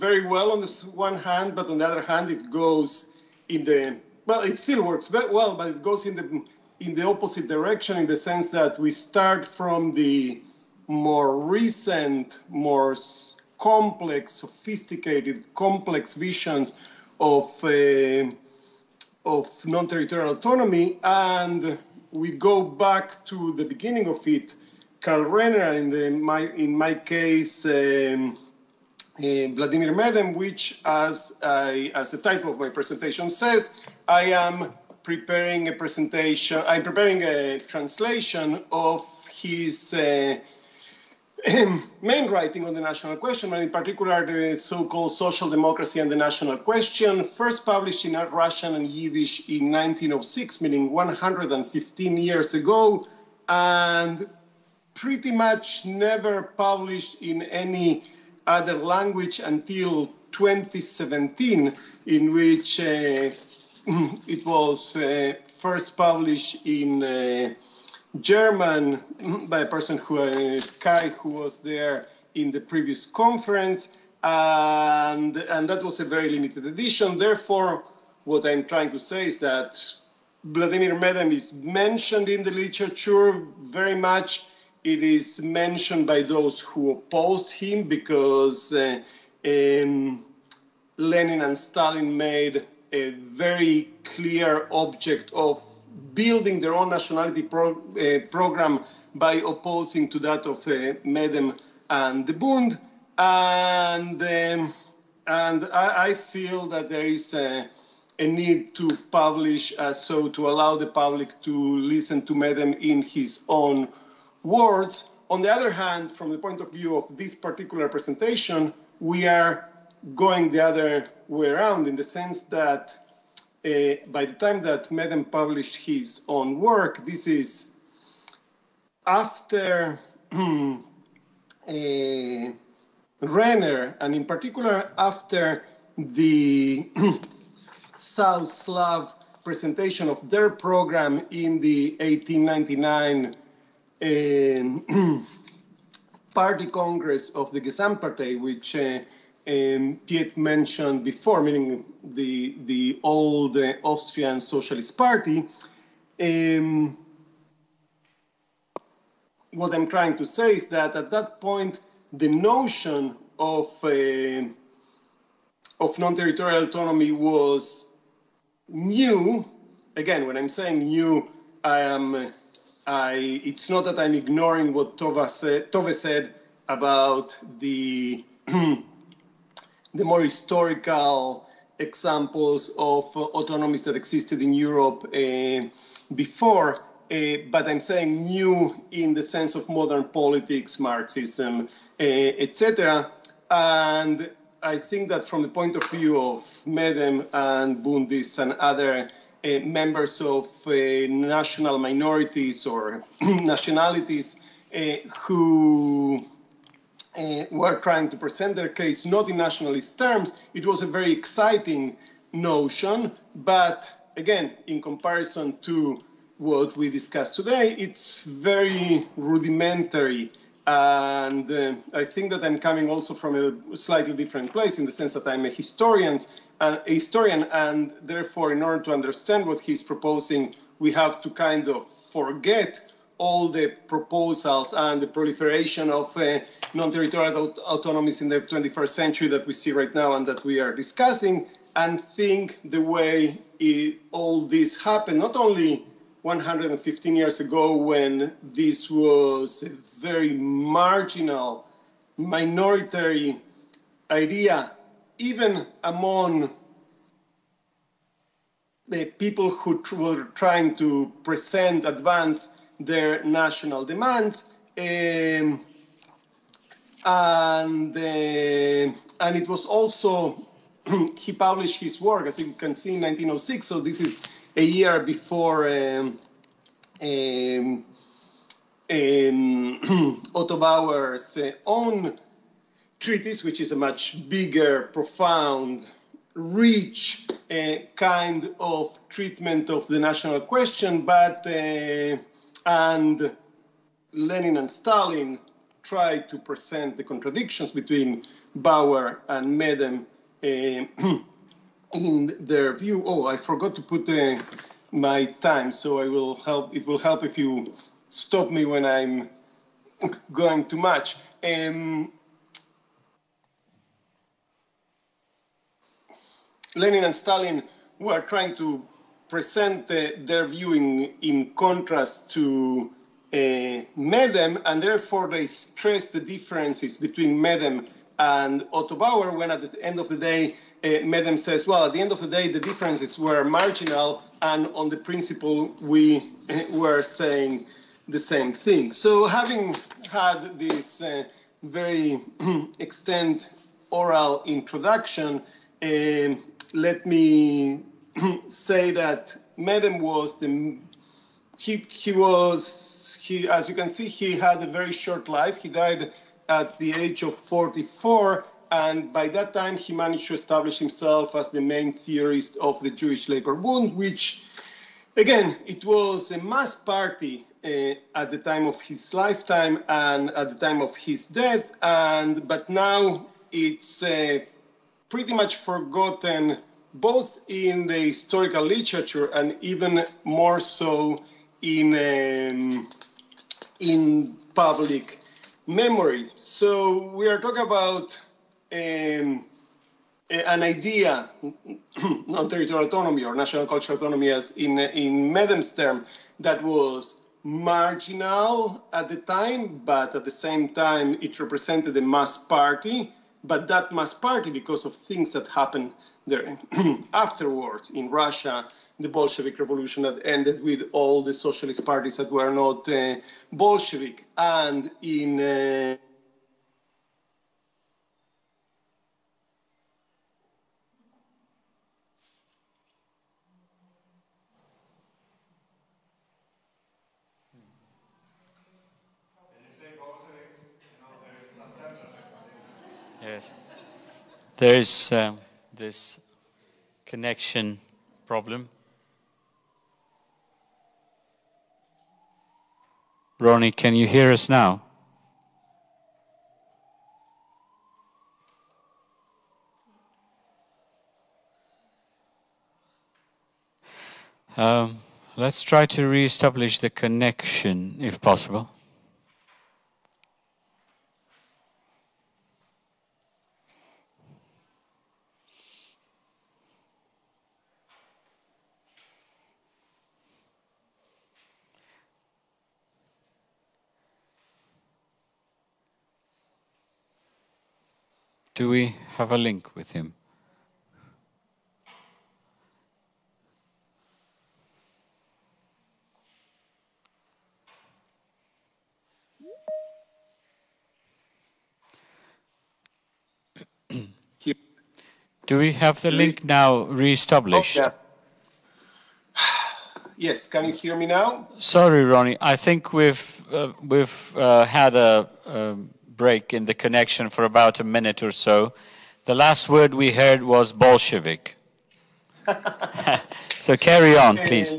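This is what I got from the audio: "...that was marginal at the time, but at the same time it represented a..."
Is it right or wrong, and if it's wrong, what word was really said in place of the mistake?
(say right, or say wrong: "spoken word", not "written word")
right.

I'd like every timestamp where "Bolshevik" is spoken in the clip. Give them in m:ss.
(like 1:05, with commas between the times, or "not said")
6:49, 6:53, 8:30.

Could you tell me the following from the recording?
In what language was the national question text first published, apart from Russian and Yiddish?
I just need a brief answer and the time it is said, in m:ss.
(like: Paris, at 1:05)
German, at 1:08.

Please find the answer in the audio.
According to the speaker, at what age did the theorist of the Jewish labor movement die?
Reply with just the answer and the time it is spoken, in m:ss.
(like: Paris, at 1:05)
44, at 5:57.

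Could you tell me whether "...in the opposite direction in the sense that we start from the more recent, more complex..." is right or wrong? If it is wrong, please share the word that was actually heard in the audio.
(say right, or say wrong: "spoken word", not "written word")
right.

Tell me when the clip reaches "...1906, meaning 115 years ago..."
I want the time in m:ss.
0:49.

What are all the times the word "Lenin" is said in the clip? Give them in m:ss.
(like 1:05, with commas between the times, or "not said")
1:30, 4:54, 5:16.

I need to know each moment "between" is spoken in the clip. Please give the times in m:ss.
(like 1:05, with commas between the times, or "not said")
4:57, 5:26.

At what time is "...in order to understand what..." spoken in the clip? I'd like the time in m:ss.
3:48.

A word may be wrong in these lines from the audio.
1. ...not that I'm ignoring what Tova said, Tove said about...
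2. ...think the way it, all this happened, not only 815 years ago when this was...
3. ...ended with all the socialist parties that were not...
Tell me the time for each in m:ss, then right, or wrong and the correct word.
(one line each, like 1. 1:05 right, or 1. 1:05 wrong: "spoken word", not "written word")
1. 2:53 right
2. 4:01 wrong: "115", not "815"
3. 6:50 right.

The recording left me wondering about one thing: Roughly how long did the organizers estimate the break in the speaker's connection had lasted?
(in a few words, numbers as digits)
about a minute.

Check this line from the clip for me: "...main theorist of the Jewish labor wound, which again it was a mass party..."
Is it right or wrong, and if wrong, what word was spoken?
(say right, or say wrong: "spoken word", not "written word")
right.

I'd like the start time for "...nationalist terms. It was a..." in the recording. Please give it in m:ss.
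3:29.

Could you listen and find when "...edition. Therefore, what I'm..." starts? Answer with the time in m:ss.
1:16.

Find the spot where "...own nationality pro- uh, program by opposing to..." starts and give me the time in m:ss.
1:36.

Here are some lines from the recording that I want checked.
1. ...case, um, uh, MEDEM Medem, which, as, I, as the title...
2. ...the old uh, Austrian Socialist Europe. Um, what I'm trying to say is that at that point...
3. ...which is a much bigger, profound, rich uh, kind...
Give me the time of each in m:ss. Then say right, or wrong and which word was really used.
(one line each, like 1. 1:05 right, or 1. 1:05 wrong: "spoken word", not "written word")
1. 0:26 wrong: "Vladimir", not "MEDEM"
2. 2:32 wrong: "Party", not "Europe"
3. 4:43 right.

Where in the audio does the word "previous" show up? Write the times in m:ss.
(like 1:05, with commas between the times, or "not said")
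1:12.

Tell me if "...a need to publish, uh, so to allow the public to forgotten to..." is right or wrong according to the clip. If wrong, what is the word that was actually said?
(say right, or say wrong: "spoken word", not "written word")
wrong: "listen", not "forgotten".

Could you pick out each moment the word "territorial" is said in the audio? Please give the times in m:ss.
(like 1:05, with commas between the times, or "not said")
0:19, 2:45, 3:56, 6:32.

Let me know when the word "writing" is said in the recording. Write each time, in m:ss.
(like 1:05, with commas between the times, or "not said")
0:42.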